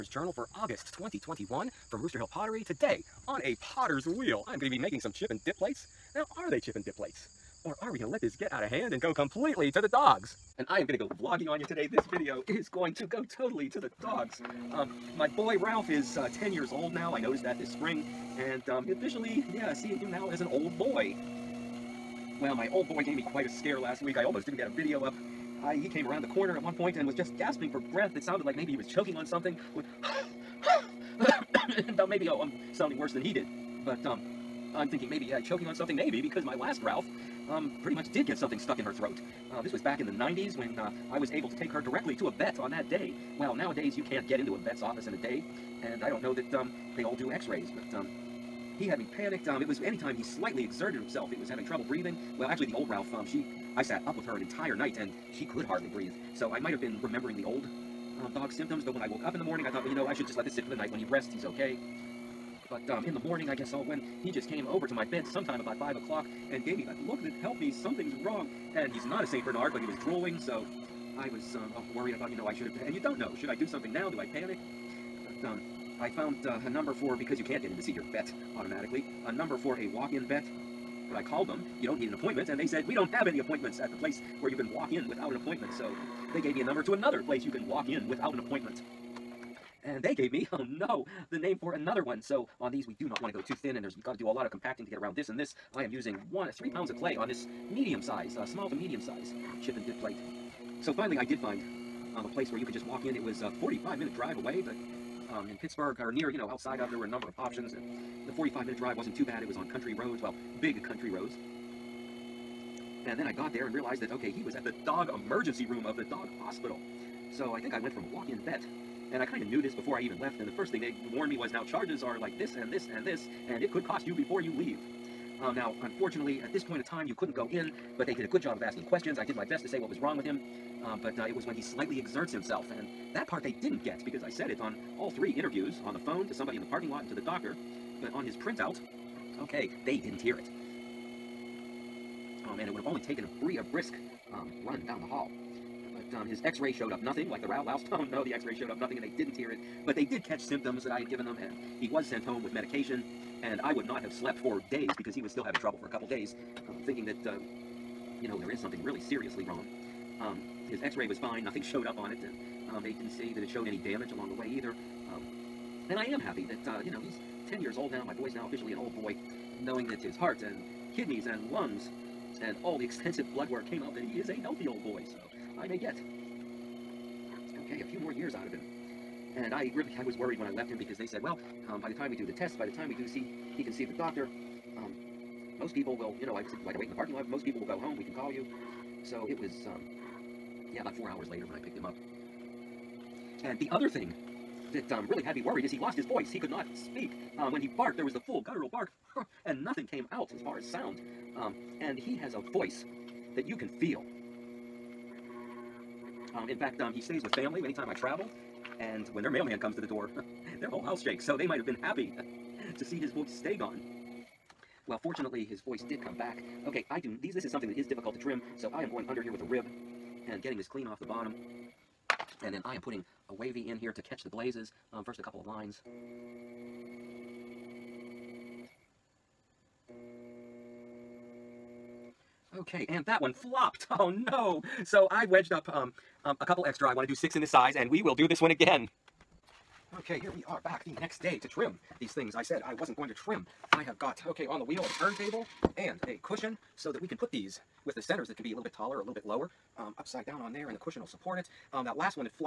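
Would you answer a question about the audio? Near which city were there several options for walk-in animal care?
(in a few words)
Pittsburgh.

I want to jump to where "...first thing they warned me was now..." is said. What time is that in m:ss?
2:00.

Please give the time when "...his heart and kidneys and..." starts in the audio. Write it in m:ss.
2:49.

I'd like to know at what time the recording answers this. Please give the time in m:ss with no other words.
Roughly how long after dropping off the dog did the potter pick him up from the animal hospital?
3:10.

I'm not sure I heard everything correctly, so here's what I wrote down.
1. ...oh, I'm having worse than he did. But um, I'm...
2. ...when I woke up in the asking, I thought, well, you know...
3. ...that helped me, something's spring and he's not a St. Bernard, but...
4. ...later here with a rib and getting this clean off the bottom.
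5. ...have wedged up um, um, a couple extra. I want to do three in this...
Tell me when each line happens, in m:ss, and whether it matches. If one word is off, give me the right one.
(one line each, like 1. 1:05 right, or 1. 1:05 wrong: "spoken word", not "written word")
1. 0:32 wrong: "sounding", not "having"
2. 0:58 wrong: "morning", not "asking"
3. 1:07 wrong: "wrong", not "spring"
4. 3:39 wrong: "under", not "later"
5. 3:55 wrong: "six", not "three".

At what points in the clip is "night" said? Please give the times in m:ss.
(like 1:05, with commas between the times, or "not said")
0:54, 1:00.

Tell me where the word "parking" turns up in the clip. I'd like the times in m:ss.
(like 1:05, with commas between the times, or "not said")
2:16, 3:06.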